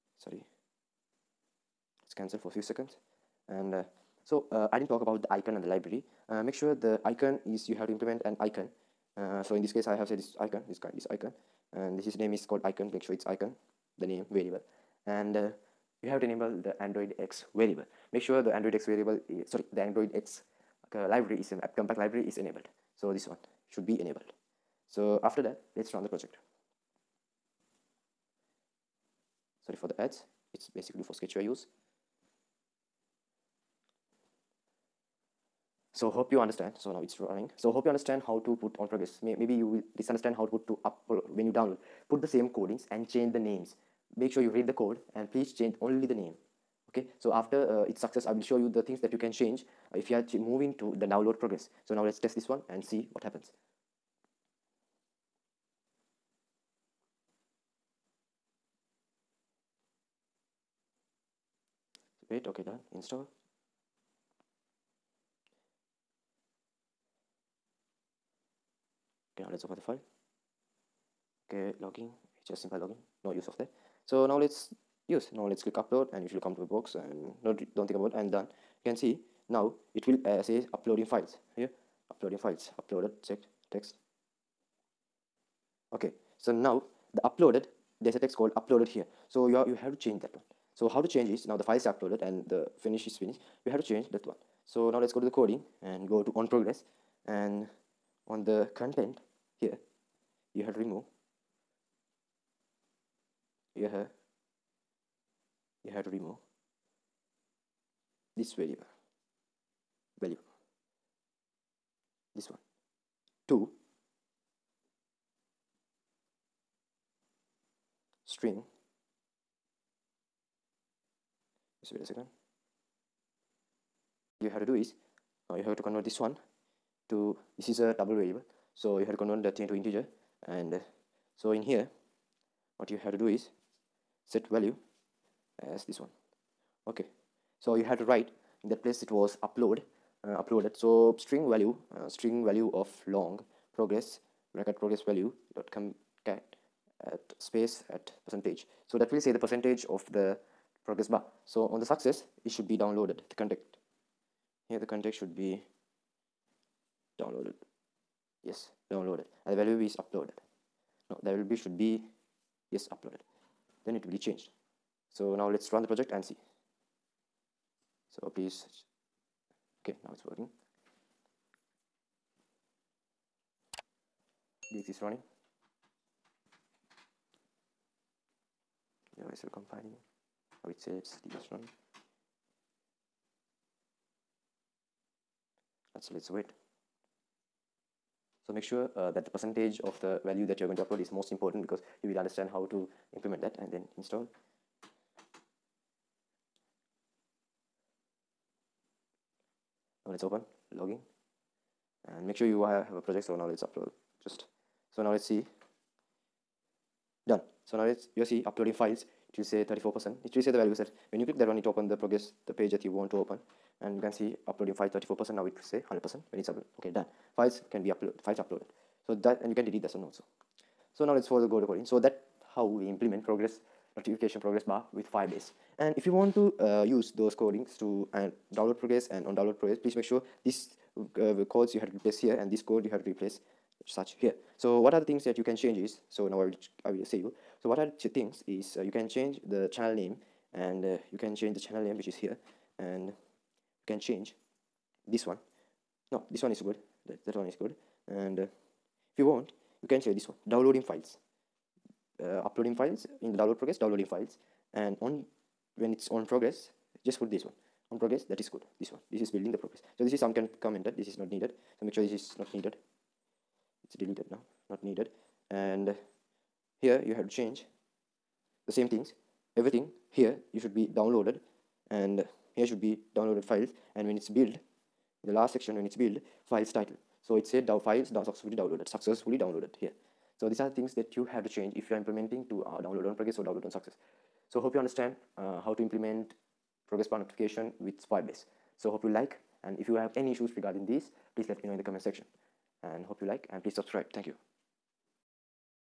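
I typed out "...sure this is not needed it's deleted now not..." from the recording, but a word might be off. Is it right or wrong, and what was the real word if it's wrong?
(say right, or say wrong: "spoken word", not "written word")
right.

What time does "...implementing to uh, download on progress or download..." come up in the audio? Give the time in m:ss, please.
4:42.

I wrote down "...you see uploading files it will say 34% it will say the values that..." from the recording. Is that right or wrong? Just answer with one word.
right.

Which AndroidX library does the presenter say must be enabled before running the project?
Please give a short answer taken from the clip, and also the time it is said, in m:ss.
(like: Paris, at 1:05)
AppCompat, at 0:21.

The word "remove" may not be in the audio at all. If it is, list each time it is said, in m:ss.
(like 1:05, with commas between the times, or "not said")
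1:40, 1:46.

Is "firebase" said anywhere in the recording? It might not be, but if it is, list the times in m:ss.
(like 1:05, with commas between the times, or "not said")
3:45, 4:48.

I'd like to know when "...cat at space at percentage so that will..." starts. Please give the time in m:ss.
2:26.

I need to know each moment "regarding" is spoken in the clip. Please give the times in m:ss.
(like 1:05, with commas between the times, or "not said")
4:50.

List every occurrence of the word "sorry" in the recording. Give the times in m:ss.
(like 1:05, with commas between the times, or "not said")
0:00, 0:19, 0:29.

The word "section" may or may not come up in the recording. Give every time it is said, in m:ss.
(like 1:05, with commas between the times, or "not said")
4:35, 4:52.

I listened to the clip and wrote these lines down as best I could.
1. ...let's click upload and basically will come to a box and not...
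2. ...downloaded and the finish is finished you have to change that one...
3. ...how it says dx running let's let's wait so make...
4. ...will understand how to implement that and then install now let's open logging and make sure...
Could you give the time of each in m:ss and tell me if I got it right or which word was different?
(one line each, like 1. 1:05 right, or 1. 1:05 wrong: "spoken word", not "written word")
1. 1:15 wrong: "usually", not "basically"
2. 1:31 wrong: "uploaded", not "downloaded"
3. 3:00 right
4. 3:12 right.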